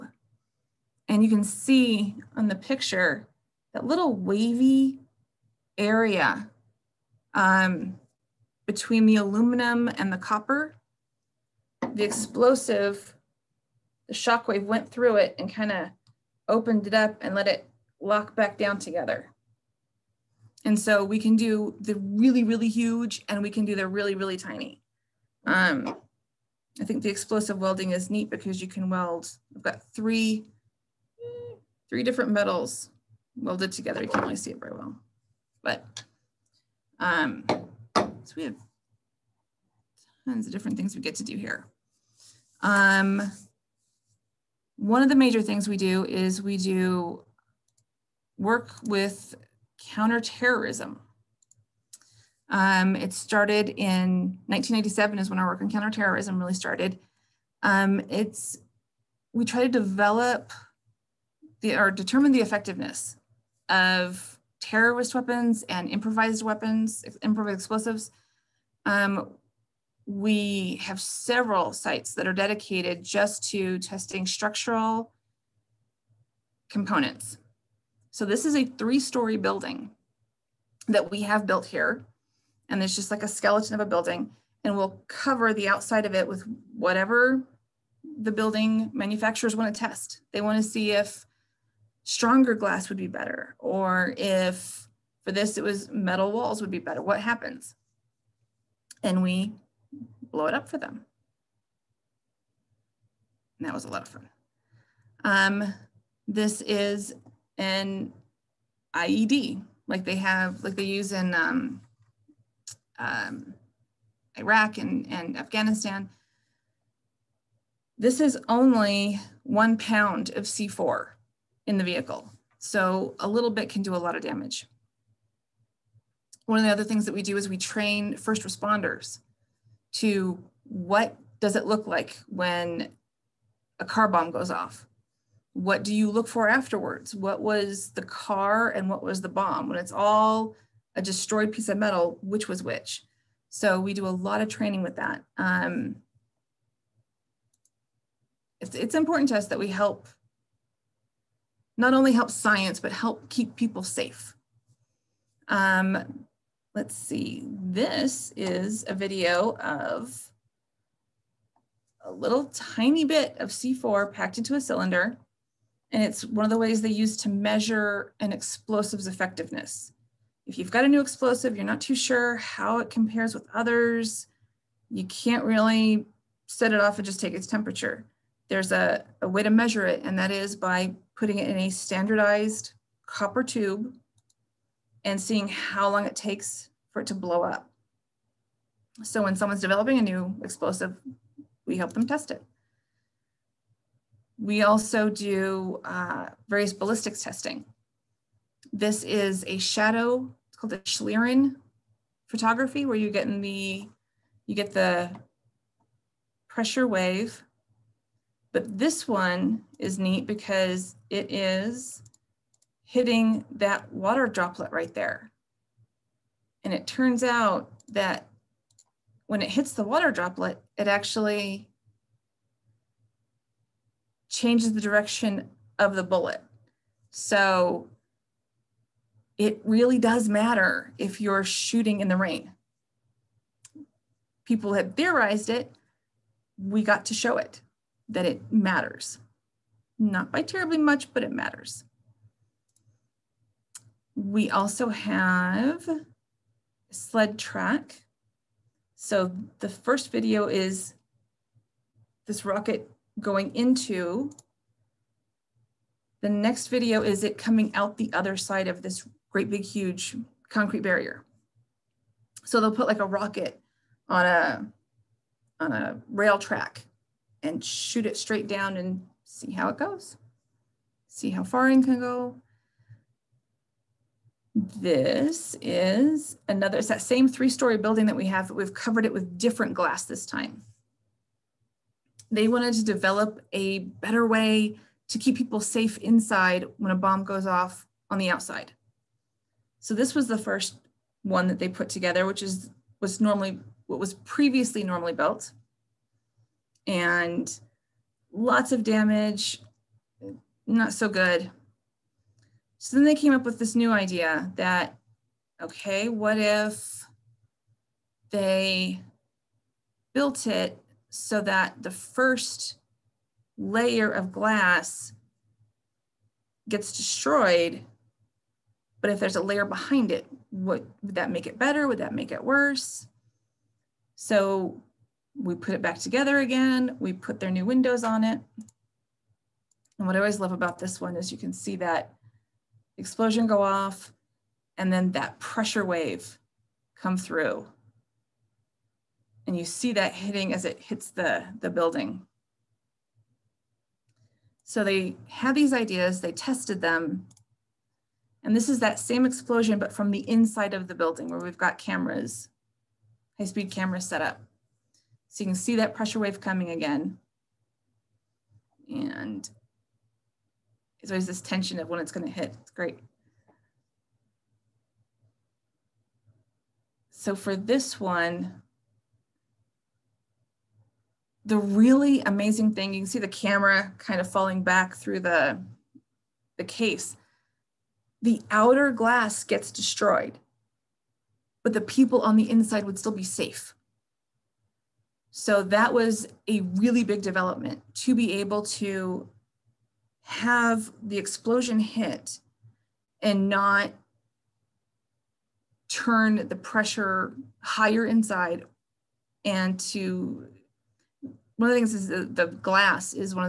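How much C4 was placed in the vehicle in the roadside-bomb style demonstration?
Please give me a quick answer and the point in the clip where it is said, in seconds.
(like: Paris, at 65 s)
1 pound, at 119 s.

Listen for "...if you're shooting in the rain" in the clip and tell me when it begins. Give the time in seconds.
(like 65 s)
230 s.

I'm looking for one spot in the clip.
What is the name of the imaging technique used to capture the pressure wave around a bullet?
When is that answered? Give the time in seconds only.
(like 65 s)
200 s.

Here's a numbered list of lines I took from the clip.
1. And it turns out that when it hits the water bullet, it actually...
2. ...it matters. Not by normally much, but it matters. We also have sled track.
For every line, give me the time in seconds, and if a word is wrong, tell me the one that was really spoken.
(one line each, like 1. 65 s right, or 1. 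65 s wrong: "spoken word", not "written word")
1. 216 s wrong: "droplet", not "bullet"
2. 238 s wrong: "terribly", not "normally".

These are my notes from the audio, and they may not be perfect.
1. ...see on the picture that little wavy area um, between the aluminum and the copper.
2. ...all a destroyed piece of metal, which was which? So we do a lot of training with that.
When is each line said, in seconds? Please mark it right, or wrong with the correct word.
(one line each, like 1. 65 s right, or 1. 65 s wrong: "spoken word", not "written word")
1. 1 s right
2. 139 s right.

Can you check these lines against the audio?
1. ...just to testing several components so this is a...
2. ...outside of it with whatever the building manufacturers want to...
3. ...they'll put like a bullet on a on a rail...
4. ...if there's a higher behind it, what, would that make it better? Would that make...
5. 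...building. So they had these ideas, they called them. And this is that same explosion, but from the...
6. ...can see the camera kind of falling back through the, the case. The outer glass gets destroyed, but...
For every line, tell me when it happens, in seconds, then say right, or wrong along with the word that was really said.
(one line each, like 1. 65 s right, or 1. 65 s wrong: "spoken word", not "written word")
1. 73 s wrong: "structural", not "several"
2. 85 s right
3. 262 s wrong: "rocket", not "bullet"
4. 319 s wrong: "layer", not "higher"
5. 341 s wrong: "tested", not "called"
6. 372 s right.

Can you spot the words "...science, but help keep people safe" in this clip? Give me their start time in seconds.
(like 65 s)
152 s.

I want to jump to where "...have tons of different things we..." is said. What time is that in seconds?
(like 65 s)
38 s.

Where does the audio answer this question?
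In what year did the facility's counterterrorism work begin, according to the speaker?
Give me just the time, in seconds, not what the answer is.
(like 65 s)
54 s.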